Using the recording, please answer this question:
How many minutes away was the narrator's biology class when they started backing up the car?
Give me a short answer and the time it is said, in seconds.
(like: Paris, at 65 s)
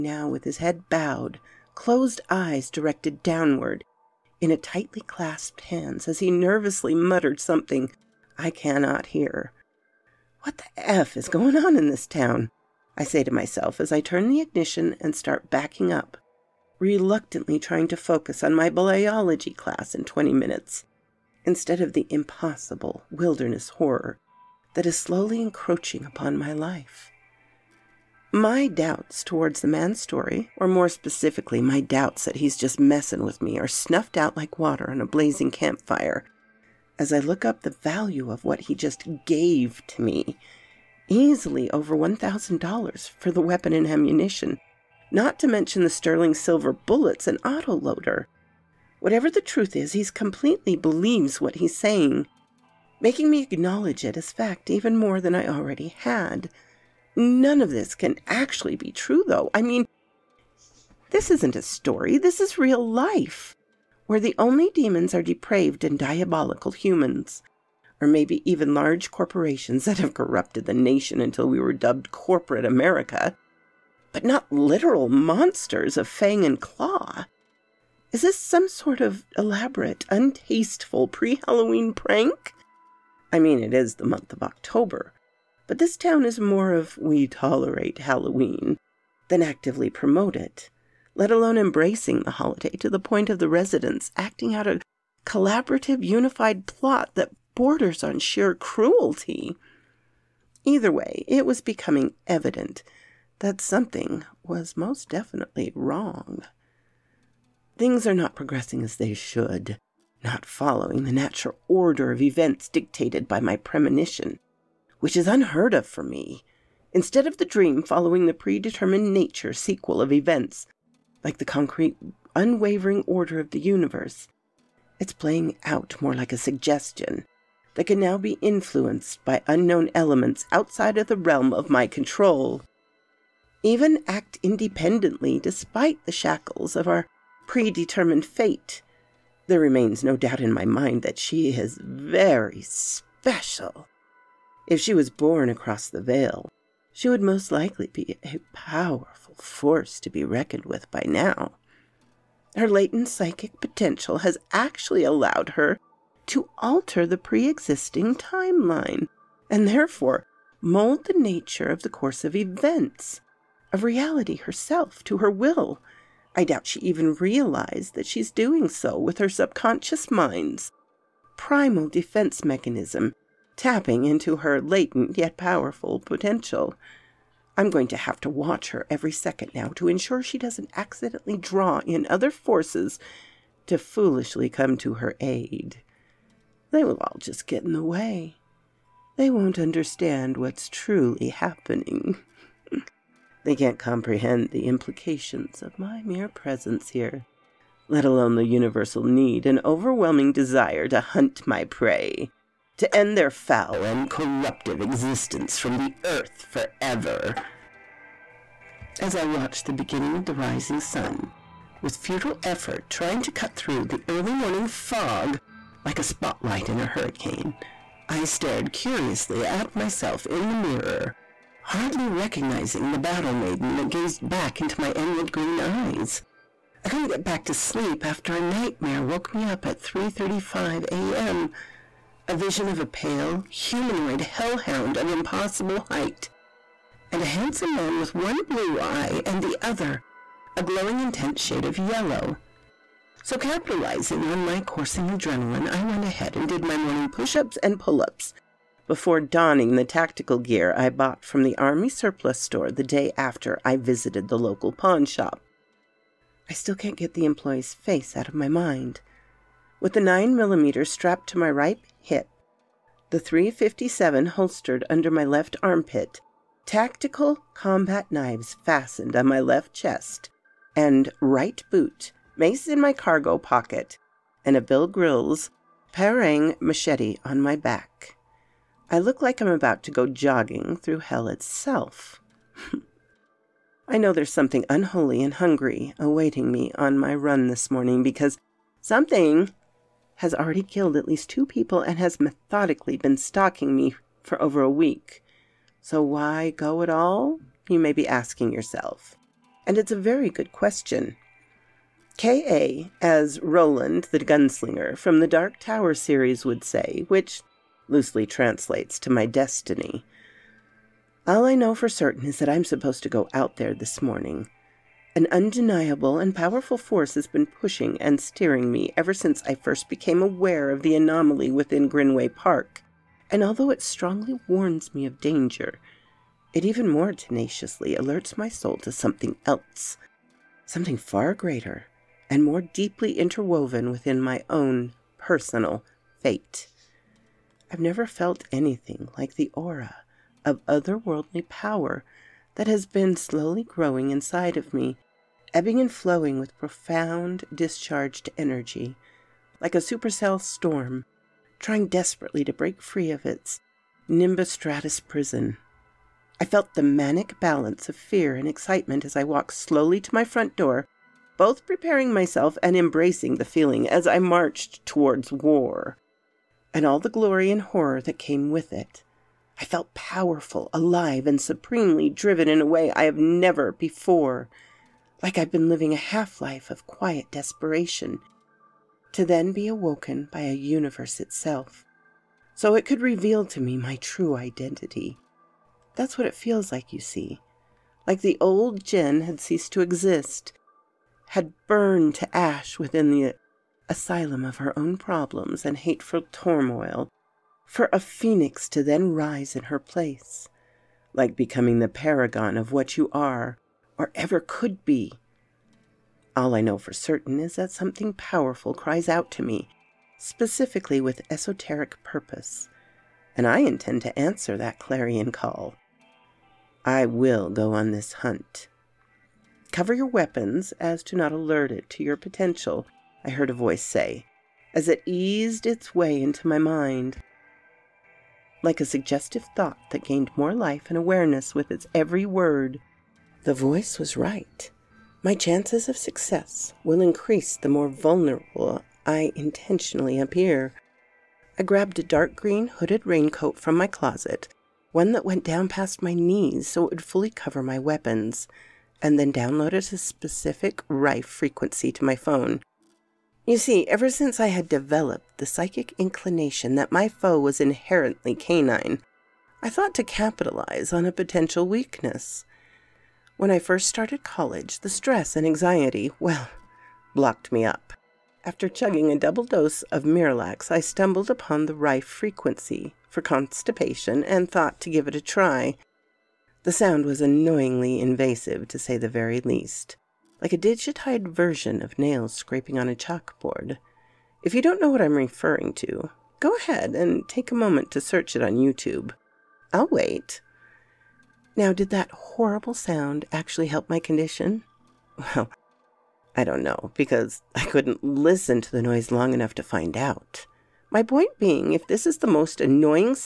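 20, at 20 s.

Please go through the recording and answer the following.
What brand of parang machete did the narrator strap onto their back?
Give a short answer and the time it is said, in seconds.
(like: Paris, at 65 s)
Bill Grylls, at 274 s.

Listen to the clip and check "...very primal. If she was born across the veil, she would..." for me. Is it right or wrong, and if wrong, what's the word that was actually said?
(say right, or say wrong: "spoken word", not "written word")
wrong: "special", not "primal".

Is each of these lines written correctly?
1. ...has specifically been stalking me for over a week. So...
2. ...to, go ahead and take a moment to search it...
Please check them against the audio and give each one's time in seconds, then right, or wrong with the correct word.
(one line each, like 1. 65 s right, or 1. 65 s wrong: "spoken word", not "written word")
1. 291 s wrong: "methodically", not "specifically"
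2. 485 s right.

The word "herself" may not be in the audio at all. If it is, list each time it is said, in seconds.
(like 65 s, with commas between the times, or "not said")
164 s.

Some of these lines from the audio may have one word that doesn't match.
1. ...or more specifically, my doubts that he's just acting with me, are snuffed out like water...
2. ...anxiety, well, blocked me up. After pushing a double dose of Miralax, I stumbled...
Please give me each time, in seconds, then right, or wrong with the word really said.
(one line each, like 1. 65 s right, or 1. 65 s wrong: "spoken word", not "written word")
1. 30 s wrong: "messing", not "acting"
2. 465 s wrong: "chugging", not "pushing".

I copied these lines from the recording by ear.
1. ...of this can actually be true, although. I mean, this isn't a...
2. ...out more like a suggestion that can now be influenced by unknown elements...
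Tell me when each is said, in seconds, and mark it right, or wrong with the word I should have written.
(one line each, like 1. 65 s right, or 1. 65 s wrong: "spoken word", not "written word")
1. 57 s wrong: "though", not "although"
2. 125 s right.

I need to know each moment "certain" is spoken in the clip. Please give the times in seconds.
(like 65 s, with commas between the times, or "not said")
311 s, 406 s.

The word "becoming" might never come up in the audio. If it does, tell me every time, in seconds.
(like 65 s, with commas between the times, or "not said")
101 s, 401 s.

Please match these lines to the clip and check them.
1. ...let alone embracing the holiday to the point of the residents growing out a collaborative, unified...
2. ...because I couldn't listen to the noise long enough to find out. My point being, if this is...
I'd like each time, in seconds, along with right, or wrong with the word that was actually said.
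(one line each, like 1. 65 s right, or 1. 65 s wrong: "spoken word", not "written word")
1. 91 s wrong: "acting", not "growing"
2. 496 s right.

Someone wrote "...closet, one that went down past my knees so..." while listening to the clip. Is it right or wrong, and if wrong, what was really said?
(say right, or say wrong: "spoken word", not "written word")
right.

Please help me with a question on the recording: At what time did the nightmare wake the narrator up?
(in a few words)
3:35 a.m.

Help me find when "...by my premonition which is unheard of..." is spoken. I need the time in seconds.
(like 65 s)
113 s.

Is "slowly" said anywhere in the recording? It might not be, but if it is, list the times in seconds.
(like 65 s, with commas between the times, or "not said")
24 s, 343 s, 359 s.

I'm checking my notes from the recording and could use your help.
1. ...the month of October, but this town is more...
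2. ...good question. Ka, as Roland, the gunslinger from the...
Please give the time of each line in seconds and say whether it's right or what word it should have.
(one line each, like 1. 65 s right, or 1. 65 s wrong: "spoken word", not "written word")
1. 83 s right
2. 300 s right.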